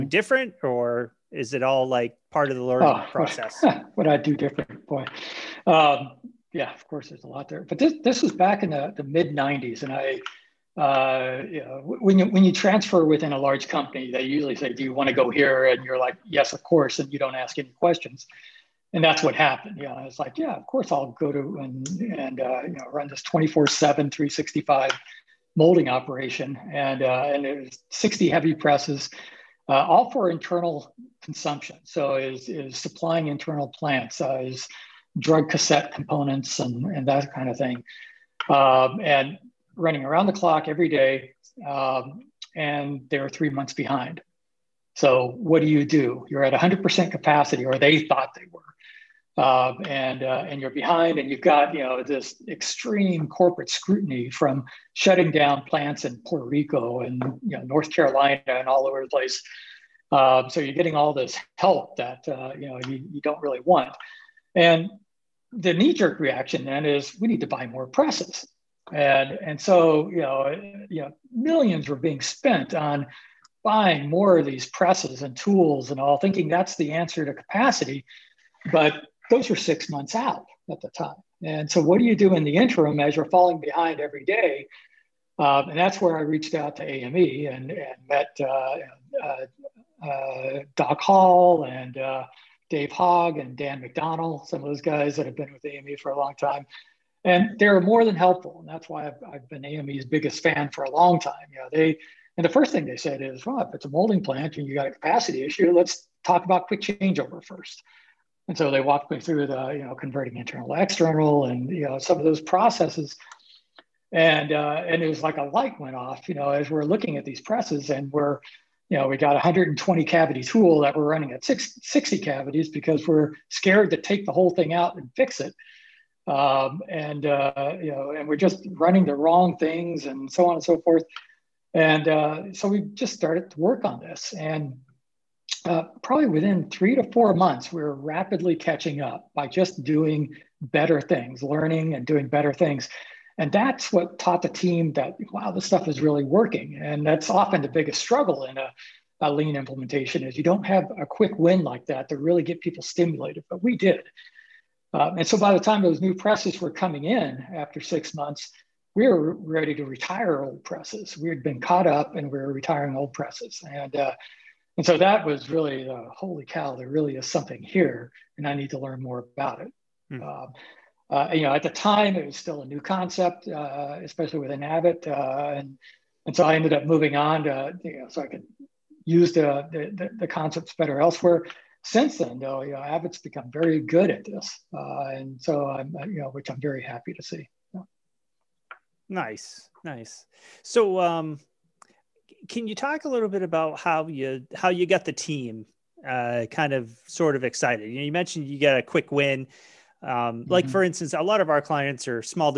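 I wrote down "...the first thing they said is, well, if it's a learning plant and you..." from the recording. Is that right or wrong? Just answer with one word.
wrong.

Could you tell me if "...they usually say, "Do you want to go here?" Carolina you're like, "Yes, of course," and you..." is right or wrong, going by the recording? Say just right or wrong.
wrong.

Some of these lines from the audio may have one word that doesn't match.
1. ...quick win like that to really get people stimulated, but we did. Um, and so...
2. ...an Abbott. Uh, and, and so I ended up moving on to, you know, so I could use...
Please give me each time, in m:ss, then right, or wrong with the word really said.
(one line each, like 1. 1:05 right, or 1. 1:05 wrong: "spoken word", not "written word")
1. 2:31 right
2. 2:54 right.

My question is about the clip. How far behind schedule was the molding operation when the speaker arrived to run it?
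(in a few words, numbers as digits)
3 months.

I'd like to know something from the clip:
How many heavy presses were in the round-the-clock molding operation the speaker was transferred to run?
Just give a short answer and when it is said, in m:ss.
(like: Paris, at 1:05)
60, at 0:27.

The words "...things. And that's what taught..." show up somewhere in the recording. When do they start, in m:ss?
2:22.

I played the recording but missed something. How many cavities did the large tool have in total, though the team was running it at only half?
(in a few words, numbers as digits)
120.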